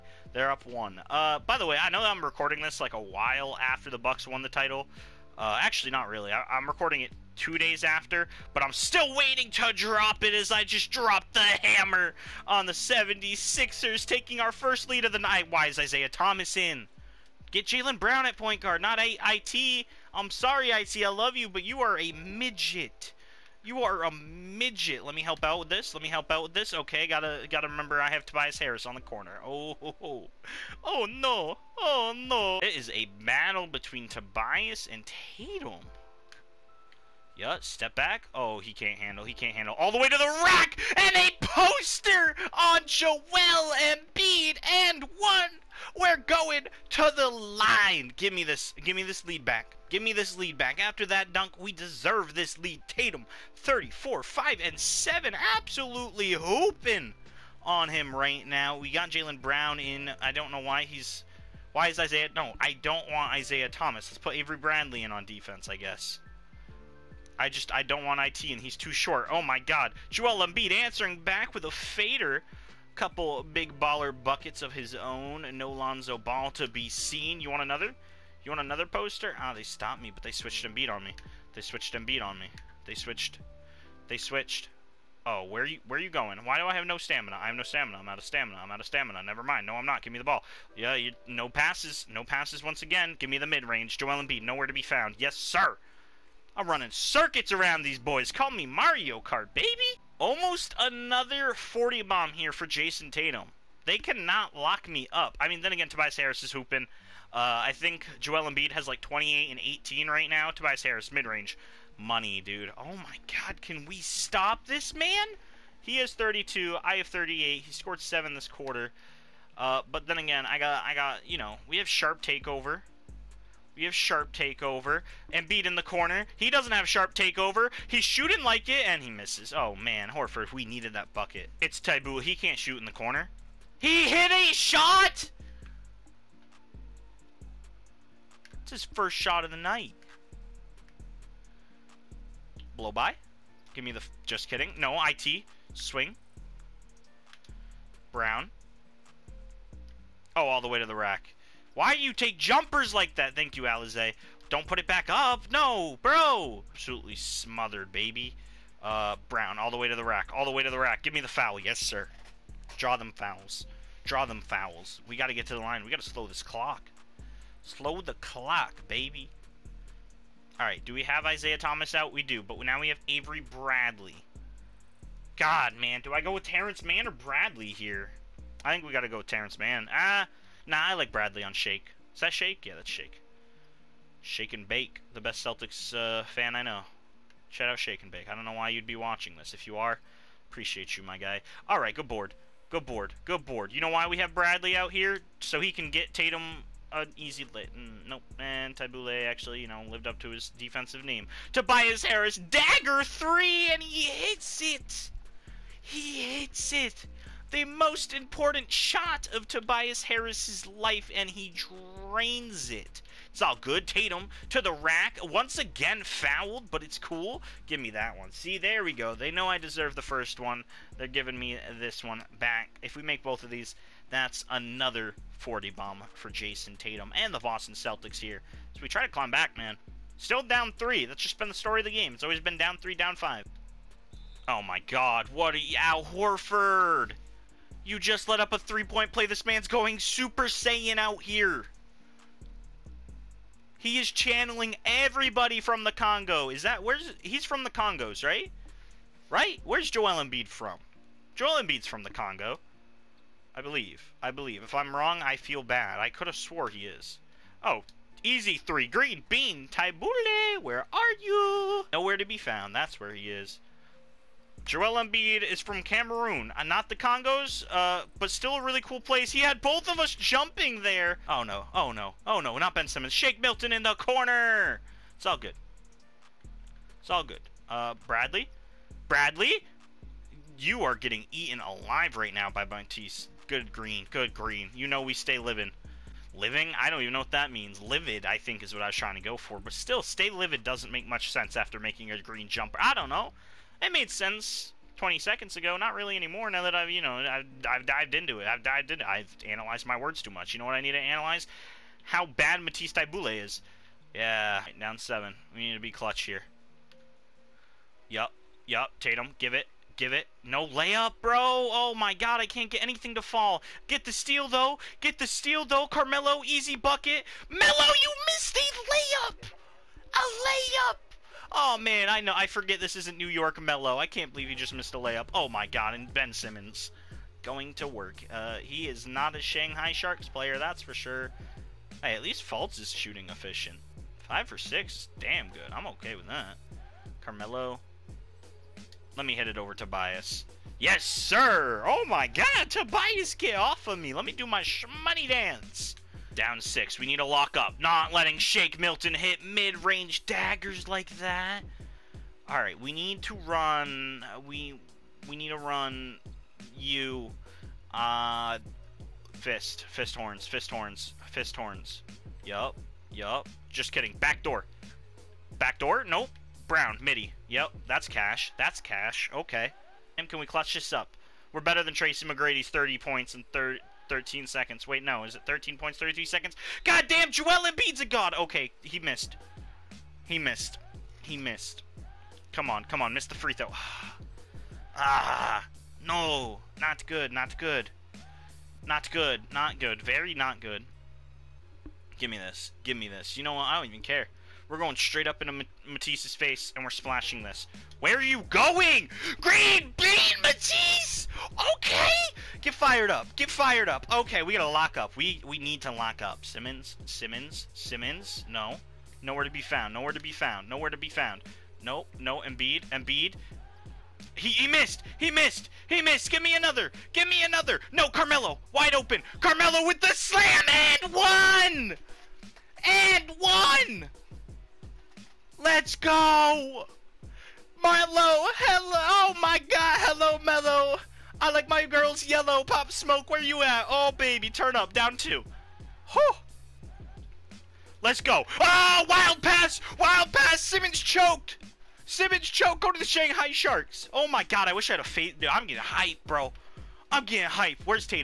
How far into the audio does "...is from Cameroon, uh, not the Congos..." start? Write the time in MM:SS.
04:25.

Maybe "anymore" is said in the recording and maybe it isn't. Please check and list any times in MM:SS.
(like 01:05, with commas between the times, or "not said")
04:56.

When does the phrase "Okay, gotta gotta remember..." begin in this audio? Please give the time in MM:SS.
00:26.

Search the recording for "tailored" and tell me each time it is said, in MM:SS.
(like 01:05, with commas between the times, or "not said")
not said.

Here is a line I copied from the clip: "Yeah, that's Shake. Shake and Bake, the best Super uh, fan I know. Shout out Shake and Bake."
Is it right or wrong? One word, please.
wrong.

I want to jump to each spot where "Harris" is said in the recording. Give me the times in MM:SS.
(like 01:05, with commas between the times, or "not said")
00:28, 01:46, 01:50, 03:22, 03:30.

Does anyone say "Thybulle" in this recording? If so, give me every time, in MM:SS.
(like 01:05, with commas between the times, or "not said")
03:18, 04:19, 05:02.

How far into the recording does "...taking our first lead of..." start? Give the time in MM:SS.
00:14.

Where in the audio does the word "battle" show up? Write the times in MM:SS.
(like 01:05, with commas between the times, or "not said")
00:33.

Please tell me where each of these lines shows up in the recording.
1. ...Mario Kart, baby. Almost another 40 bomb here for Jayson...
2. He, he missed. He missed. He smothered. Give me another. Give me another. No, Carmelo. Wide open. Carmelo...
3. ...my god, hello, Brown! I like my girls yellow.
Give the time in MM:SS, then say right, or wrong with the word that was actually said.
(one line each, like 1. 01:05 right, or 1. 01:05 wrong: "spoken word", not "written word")
1. 01:38 right
2. 06:54 wrong: "missed", not "smothered"
3. 07:09 wrong: "Melo", not "Brown".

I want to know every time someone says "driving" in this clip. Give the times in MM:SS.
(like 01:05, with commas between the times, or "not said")
not said.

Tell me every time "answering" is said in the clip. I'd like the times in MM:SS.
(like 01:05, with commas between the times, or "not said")
01:10.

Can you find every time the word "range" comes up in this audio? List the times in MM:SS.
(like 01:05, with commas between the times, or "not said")
01:33, 01:51, 05:49.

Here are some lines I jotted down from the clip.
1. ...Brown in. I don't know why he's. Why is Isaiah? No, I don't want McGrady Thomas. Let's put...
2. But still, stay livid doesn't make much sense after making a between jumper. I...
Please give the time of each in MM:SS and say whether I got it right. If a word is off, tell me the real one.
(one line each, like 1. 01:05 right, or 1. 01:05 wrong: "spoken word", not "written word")
1. 00:59 wrong: "Isaiah", not "McGrady"
2. 04:49 wrong: "green", not "between".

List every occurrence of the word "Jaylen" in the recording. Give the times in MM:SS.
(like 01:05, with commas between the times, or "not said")
00:17, 00:59.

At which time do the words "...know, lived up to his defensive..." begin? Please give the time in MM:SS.
03:19.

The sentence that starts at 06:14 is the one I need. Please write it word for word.
Wait, no, is it 13 points, 33 seconds?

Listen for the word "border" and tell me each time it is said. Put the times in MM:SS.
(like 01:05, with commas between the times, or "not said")
not said.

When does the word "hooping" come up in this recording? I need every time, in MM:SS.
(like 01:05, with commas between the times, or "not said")
00:56, 01:46.